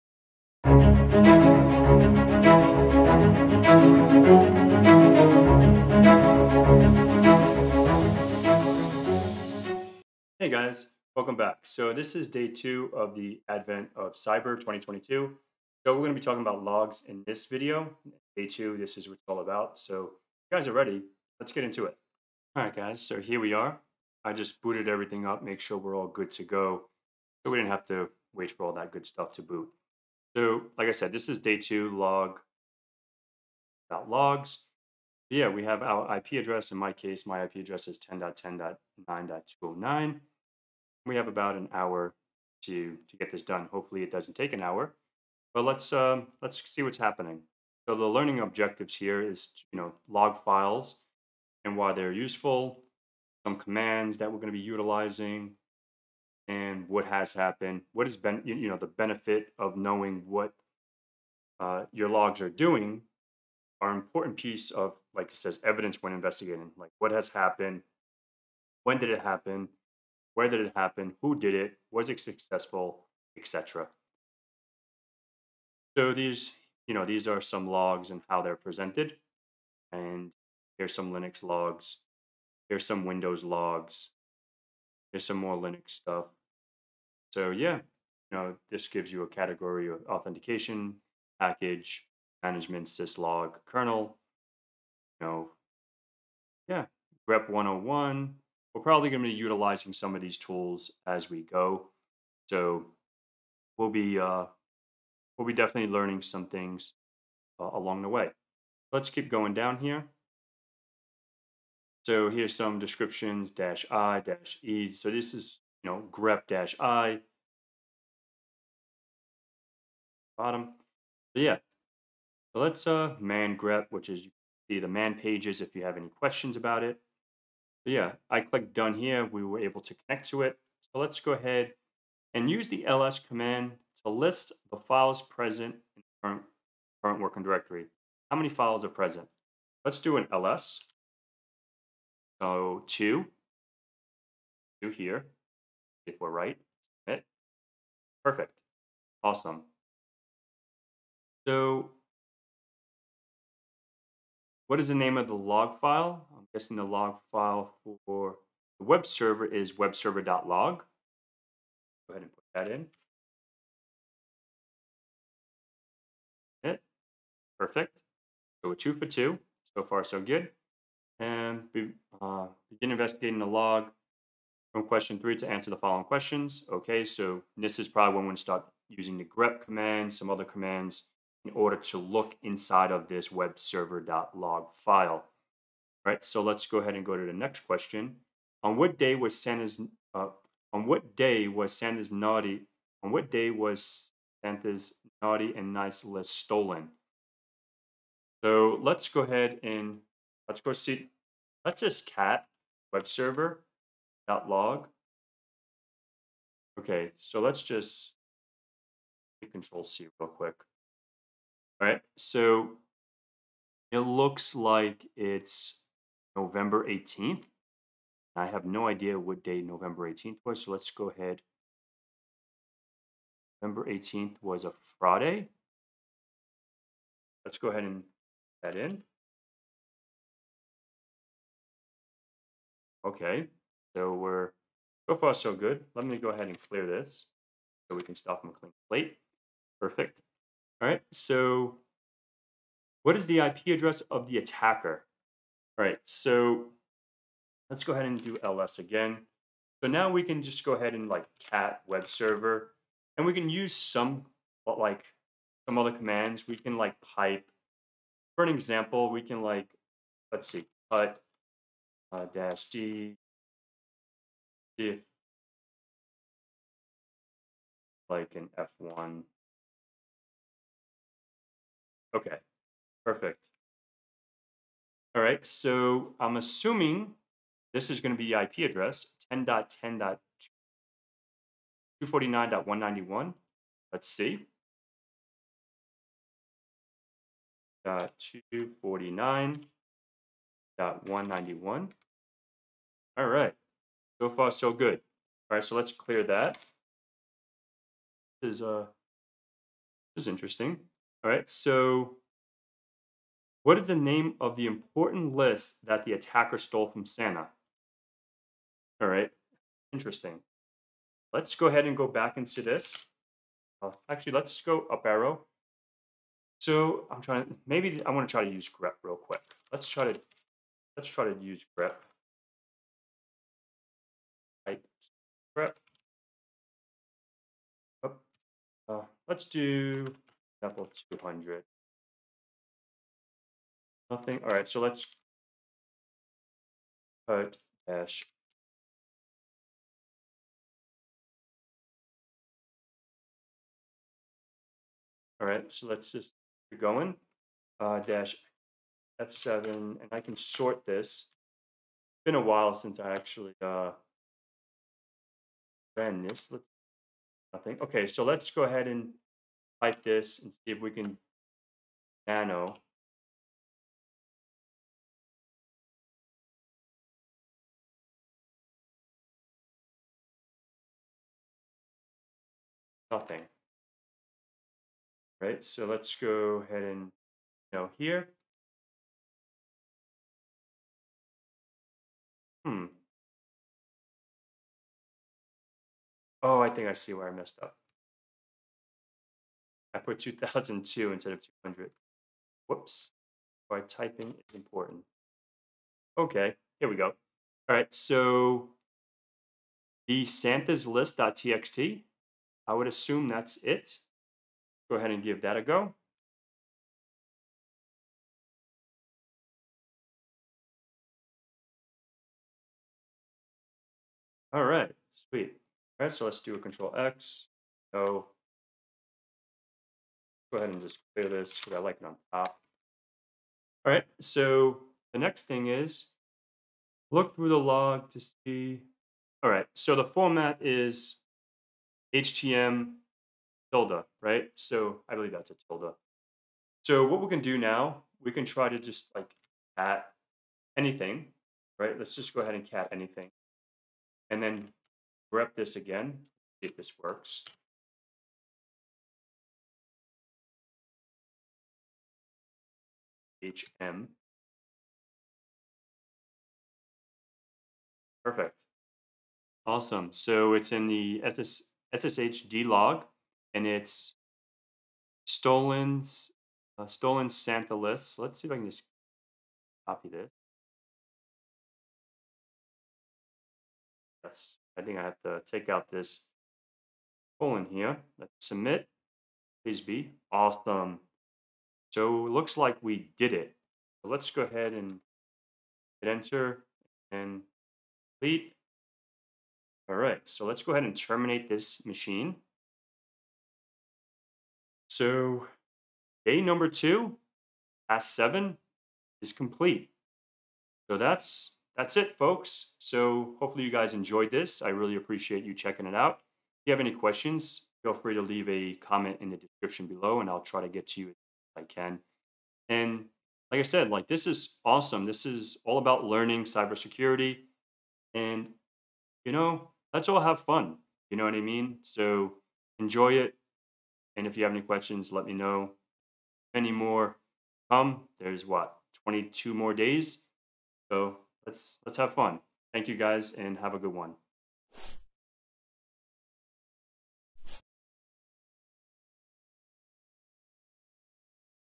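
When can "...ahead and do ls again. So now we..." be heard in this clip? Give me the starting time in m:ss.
4:07.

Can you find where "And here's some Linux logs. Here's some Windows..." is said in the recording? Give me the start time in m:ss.
1:19.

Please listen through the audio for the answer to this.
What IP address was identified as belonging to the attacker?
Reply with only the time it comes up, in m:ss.
4:39.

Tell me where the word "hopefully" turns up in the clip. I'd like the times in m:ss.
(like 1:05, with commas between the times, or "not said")
0:43, 8:23.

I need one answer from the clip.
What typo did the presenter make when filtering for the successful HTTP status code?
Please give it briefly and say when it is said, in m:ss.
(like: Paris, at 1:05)
2002 instead of 200, at 6:30.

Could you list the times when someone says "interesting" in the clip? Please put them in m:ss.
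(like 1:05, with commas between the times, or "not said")
5:00, 5:09.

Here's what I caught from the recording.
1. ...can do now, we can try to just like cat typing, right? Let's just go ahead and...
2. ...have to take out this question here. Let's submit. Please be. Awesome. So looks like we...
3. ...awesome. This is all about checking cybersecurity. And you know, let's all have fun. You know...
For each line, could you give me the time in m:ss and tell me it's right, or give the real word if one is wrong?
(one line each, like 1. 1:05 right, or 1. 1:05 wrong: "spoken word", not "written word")
1. 7:17 wrong: "anything", not "typing"
2. 7:55 wrong: "colon", not "question"
3. 8:34 wrong: "learning", not "checking".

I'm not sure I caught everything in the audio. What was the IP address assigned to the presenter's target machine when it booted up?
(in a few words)
10.10.9.209.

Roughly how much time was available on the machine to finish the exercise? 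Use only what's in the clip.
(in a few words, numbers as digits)
About an hour.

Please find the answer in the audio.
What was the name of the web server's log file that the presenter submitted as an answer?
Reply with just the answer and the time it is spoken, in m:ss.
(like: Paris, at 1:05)
webserver.log, at 2:39.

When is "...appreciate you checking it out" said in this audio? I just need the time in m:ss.
8:24.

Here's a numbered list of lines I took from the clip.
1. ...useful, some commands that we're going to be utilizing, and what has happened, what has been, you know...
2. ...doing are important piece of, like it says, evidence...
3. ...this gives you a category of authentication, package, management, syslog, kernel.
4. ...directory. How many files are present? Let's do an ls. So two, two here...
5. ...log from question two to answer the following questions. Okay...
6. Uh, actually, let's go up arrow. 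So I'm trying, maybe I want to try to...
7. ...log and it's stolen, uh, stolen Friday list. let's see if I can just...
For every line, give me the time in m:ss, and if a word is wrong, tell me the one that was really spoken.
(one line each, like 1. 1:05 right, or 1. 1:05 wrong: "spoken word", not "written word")
1. 0:52 right
2. 1:02 right
3. 1:28 right
4. 2:17 right
5. 2:53 wrong: "three", not "two"
6. 5:13 right
7. 7:42 wrong: "Santa", not "Friday".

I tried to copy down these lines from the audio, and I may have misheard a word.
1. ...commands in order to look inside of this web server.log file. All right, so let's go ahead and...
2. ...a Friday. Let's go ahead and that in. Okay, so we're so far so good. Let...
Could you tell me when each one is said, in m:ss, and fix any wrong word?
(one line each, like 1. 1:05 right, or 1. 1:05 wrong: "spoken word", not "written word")
1. 3:00 right
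2. 3:44 right.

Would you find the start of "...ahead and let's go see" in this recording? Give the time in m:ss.
3:19.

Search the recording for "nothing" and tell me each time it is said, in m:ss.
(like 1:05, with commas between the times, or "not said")
5:34, 5:57, 6:13.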